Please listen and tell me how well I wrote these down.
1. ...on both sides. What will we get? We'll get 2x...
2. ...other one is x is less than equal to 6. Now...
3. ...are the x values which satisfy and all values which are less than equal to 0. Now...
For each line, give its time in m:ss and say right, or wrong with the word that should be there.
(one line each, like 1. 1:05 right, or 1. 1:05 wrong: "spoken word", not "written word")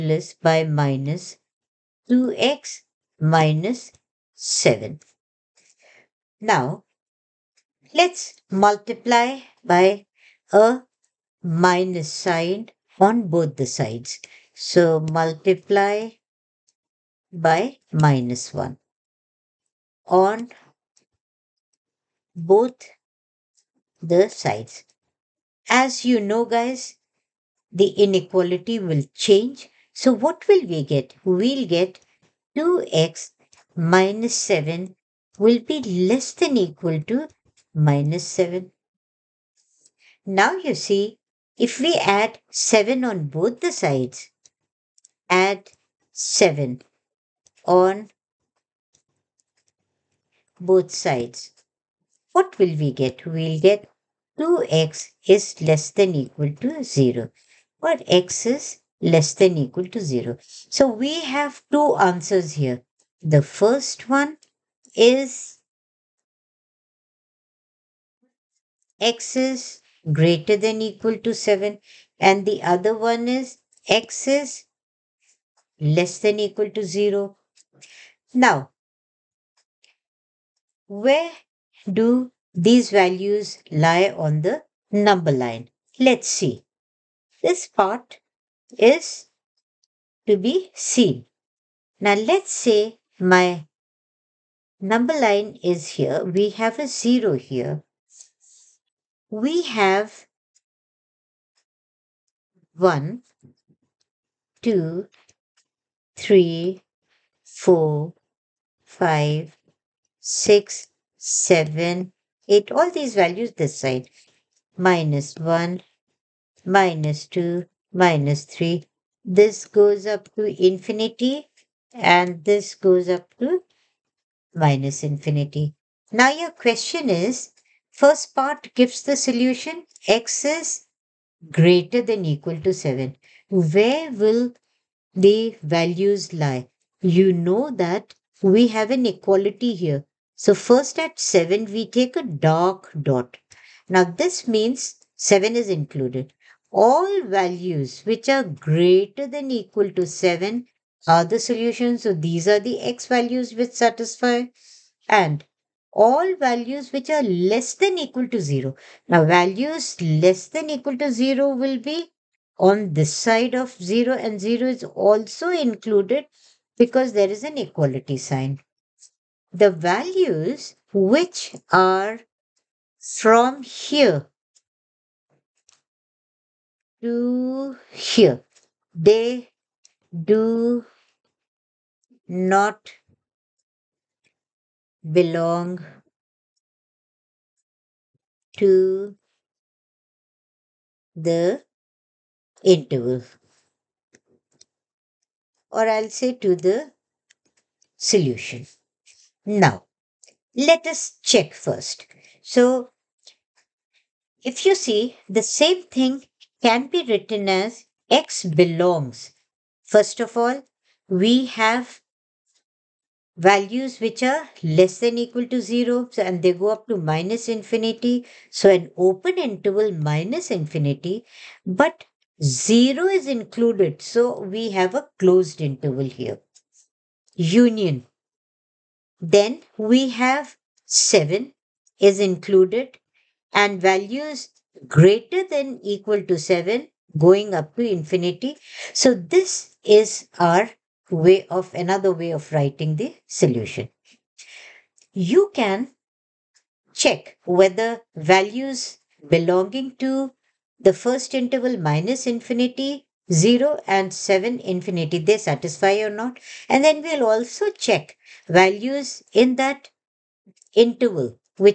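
1. 0:47 right
2. 1:12 wrong: "0", not "6"
3. 2:32 right.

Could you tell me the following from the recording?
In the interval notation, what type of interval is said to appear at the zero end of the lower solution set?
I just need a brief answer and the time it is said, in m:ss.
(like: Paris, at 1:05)
closed interval, at 3:45.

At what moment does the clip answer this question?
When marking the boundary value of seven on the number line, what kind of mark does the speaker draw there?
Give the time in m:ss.
2:22.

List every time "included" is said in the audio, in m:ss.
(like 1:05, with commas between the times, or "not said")
2:25, 2:45, 3:43, 3:52.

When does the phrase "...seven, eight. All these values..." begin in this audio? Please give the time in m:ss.
1:51.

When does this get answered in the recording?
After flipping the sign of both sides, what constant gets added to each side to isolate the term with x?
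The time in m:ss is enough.
0:41.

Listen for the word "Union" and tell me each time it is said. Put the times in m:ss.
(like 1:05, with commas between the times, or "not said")
3:47.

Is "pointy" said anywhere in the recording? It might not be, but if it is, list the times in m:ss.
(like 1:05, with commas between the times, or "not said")
not said.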